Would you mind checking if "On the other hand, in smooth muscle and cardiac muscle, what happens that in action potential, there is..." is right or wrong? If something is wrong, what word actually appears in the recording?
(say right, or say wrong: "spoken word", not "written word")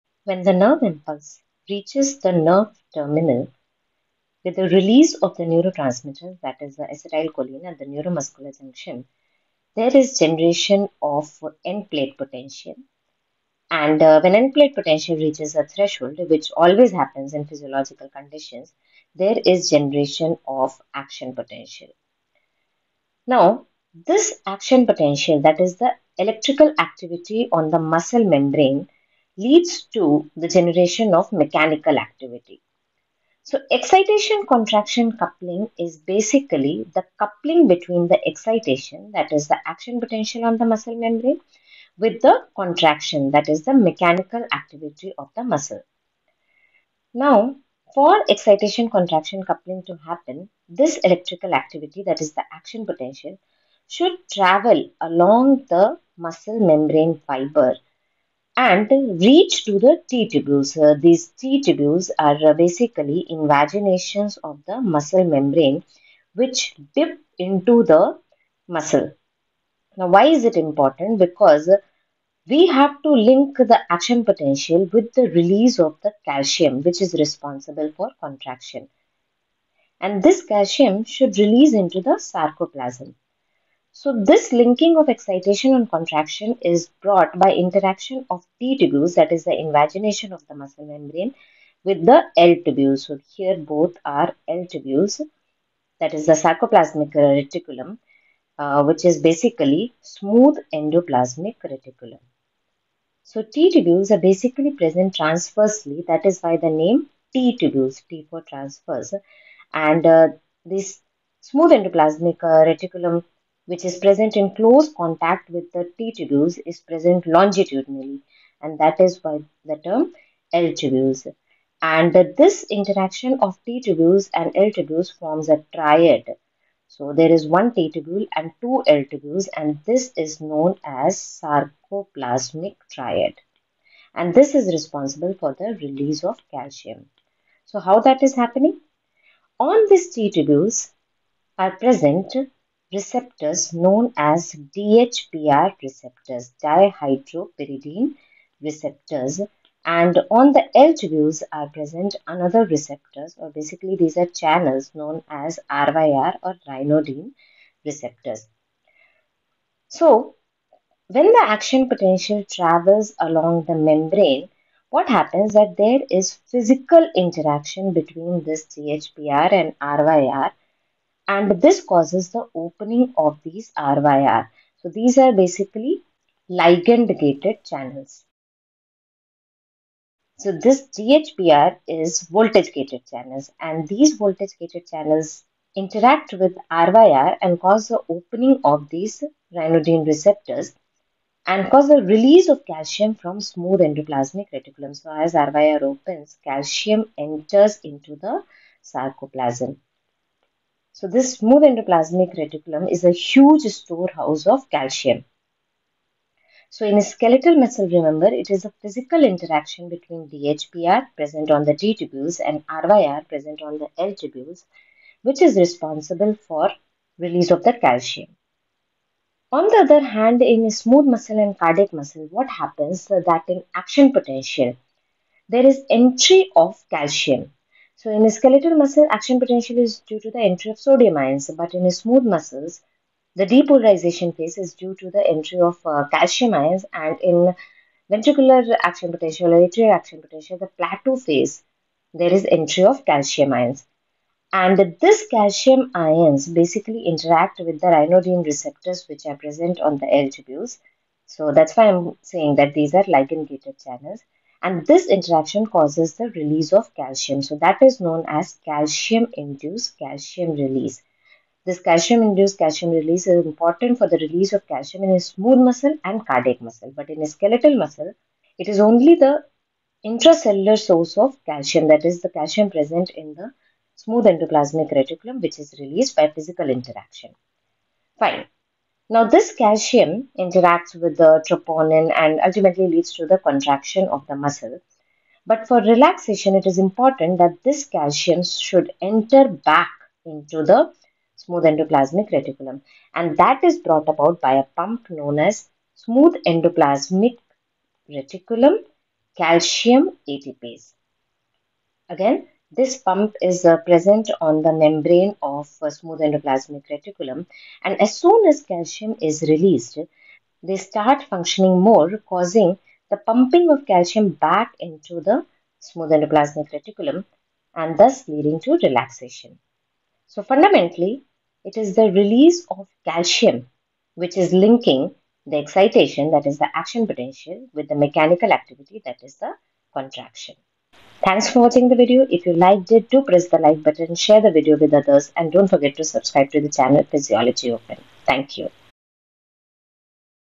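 right.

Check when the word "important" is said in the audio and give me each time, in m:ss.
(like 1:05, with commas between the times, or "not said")
1:10, 4:23, 4:46.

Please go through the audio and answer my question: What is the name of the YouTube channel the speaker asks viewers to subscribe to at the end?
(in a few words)
Physiology Open.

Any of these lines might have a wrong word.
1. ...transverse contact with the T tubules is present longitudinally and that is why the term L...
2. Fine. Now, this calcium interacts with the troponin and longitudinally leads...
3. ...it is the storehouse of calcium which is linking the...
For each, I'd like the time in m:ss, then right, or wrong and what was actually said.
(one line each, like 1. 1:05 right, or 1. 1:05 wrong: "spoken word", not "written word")
1. 1:54 wrong: "close", not "transverse"
2. 4:38 wrong: "ultimately", not "longitudinally"
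3. 5:21 wrong: "release", not "storehouse".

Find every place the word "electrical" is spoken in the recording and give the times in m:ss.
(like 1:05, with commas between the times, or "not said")
0:26, 0:50.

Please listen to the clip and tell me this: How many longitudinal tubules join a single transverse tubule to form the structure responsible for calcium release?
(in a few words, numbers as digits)
2.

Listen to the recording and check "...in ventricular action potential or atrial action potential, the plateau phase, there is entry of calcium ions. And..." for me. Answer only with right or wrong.
right.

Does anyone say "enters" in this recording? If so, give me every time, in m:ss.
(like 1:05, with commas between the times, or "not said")
3:17, 4:49.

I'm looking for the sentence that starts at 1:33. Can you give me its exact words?
So here both are L tubules, that is the sarcoplasmic reticulum, uh, which is basically smooth endoplasmic reticulum.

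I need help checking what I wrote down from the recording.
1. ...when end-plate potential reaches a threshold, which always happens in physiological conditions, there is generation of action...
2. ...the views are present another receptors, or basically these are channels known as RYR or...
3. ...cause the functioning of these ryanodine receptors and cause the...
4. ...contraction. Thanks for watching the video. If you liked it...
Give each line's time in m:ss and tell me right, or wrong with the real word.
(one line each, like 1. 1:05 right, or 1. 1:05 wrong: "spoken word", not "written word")
1. 0:14 right
2. 2:30 right
3. 3:07 wrong: "opening", not "functioning"
4. 5:29 right.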